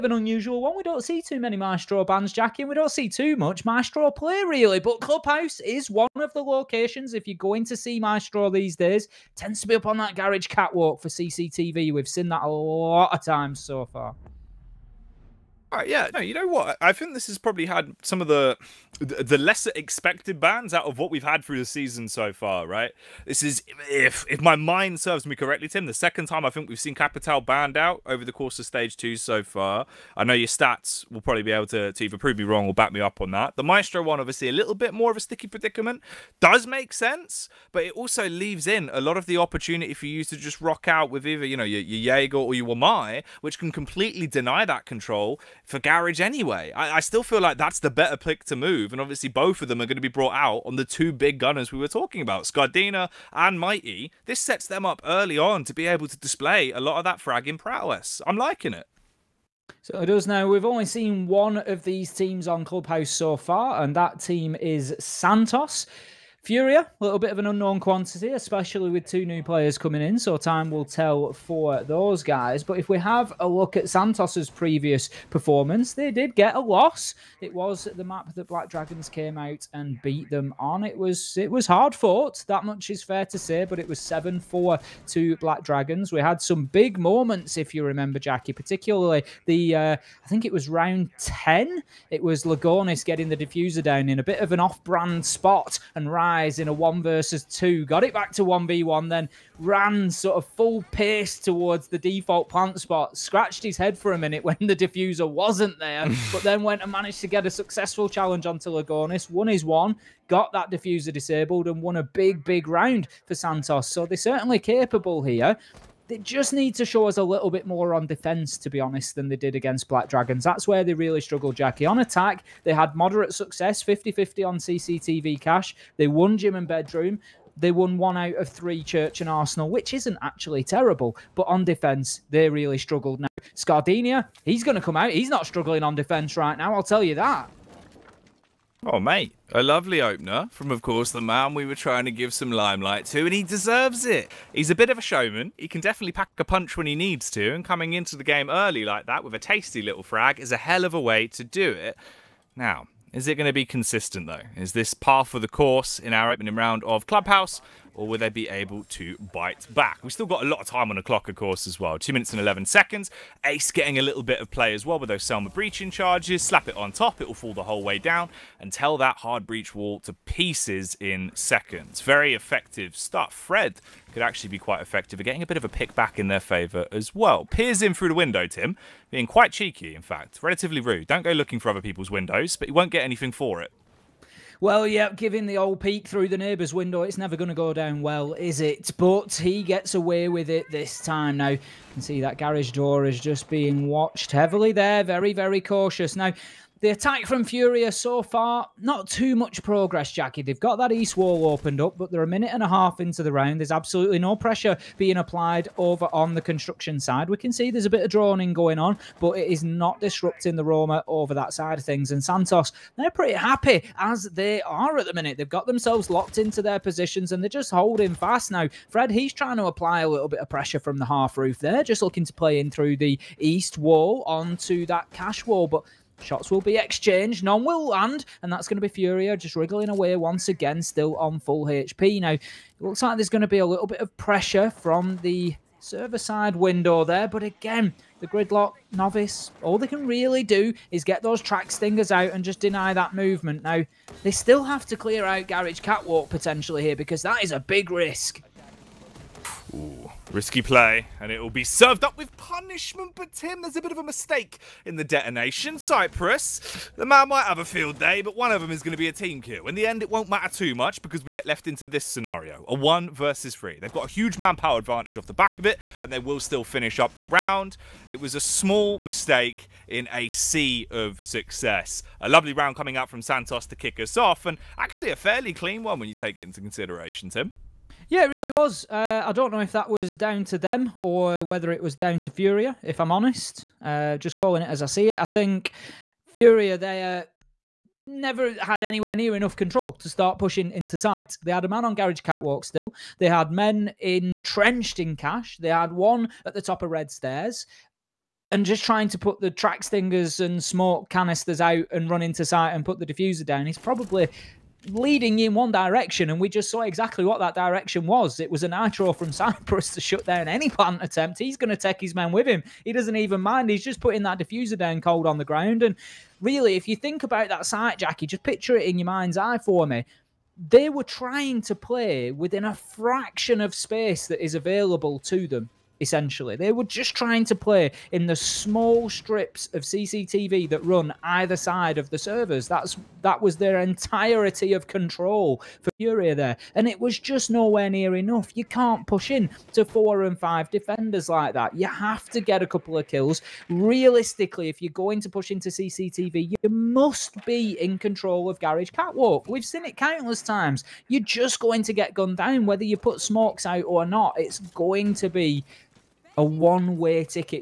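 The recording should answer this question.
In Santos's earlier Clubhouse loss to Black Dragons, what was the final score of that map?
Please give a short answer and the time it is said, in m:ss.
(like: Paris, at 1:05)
7-4, at 1:23.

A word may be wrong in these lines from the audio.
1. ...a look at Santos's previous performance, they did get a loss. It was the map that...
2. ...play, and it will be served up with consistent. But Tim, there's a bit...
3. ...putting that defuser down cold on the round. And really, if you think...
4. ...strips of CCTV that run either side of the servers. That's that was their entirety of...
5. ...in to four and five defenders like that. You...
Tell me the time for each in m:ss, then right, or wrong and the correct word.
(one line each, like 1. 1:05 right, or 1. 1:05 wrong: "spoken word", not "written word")
1. 1:13 right
2. 4:10 wrong: "punishment", not "consistent"
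3. 5:13 wrong: "ground", not "round"
4. 5:29 right
5. 5:39 right.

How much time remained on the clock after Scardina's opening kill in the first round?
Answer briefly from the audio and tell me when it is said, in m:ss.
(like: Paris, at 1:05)
2 minutes and 11 seconds, at 2:41.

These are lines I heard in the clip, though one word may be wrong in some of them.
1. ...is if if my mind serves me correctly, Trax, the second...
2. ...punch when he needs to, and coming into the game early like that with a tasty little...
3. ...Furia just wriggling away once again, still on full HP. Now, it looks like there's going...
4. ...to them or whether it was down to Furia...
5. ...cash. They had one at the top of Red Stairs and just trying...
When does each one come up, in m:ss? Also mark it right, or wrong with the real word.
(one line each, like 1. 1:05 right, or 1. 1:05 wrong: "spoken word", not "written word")
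1. 0:23 wrong: "Tim", not "Trax"
2. 2:26 right
3. 3:48 right
4. 4:40 right
5. 4:55 right.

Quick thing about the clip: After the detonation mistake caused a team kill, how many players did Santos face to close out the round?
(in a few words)
1 versus 3.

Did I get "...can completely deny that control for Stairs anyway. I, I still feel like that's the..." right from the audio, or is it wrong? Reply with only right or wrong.
wrong.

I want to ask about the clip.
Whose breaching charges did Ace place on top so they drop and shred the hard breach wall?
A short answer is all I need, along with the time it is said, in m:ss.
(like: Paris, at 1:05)
Selma, at 2:45.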